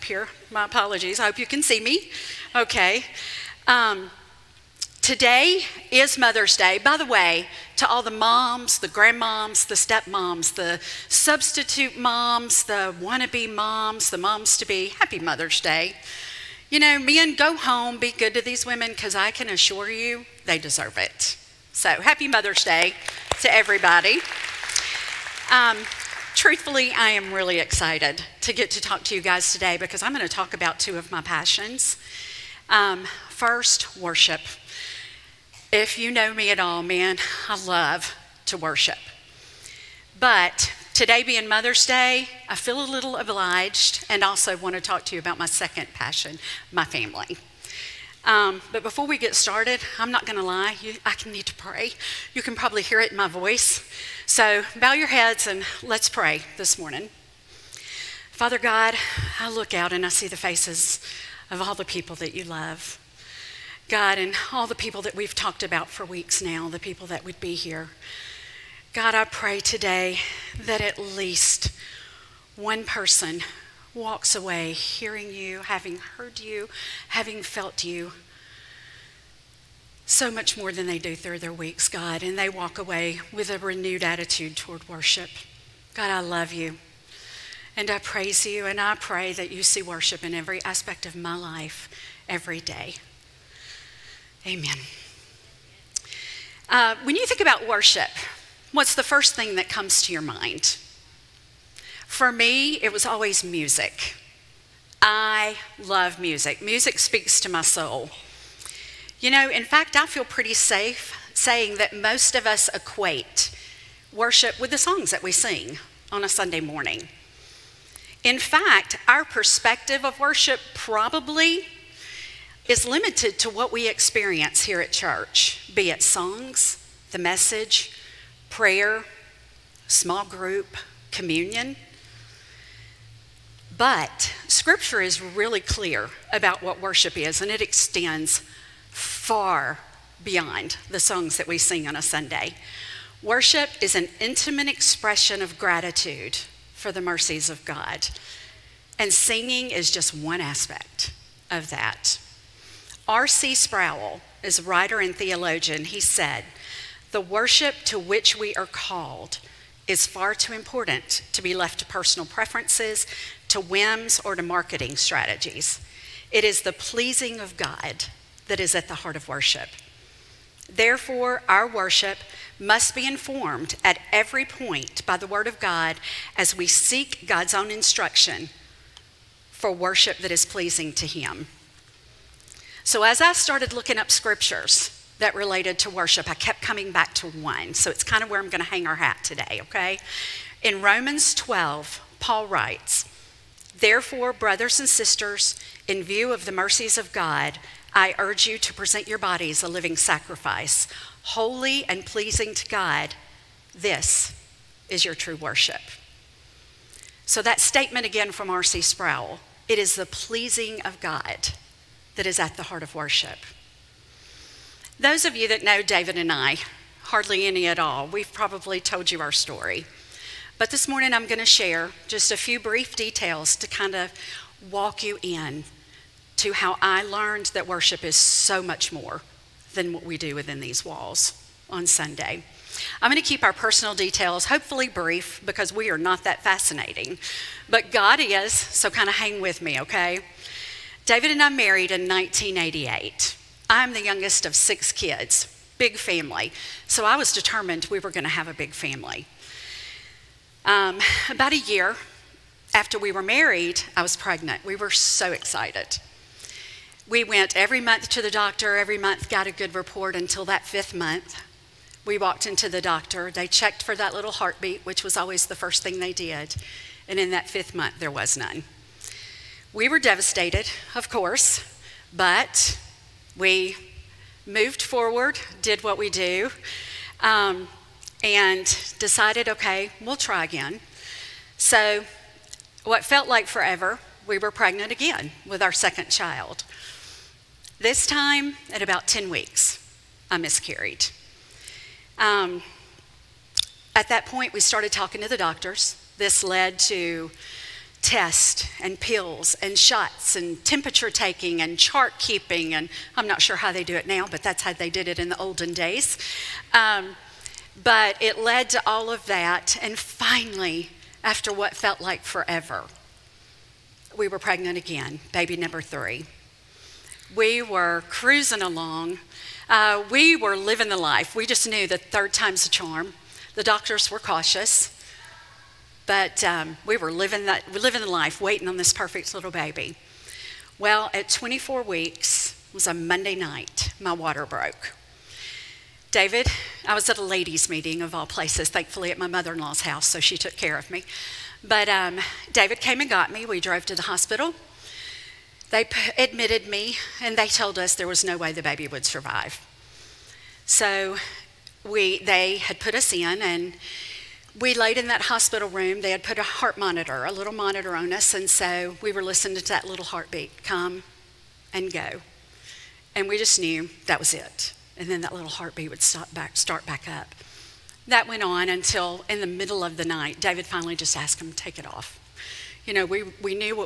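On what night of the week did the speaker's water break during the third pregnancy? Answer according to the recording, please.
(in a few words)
Monday.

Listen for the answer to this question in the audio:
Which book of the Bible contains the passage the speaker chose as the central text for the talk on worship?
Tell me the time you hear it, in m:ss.
3:10.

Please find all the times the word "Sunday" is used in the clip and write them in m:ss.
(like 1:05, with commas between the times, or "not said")
1:56, 2:22, 3:51.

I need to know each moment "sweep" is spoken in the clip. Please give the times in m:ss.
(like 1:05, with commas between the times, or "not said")
not said.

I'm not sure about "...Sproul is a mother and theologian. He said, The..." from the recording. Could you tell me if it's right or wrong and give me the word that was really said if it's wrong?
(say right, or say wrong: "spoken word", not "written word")
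wrong: "writer", not "mother".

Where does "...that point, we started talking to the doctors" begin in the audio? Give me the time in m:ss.
4:54.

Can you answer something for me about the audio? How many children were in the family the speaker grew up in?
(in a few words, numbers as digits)
6.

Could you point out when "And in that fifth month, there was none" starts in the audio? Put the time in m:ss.
4:27.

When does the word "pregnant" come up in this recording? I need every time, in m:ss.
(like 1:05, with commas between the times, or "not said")
4:14, 4:44, 5:14.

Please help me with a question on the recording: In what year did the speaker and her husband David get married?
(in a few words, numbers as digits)
1988.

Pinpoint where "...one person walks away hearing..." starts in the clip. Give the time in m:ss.
1:12.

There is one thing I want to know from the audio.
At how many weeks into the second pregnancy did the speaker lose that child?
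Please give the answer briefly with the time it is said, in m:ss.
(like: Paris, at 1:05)
10, at 4:49.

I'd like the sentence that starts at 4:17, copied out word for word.
We went every month to the doctor, every month got a good report until that fifth month.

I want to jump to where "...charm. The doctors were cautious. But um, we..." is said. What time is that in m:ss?
5:22.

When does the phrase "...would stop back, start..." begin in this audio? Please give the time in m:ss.
6:05.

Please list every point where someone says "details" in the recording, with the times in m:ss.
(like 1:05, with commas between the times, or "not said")
3:42, 3:53.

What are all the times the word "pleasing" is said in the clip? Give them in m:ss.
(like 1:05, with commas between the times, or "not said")
2:46, 3:00, 3:22, 3:30.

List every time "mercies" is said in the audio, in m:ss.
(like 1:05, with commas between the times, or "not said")
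2:27, 3:16.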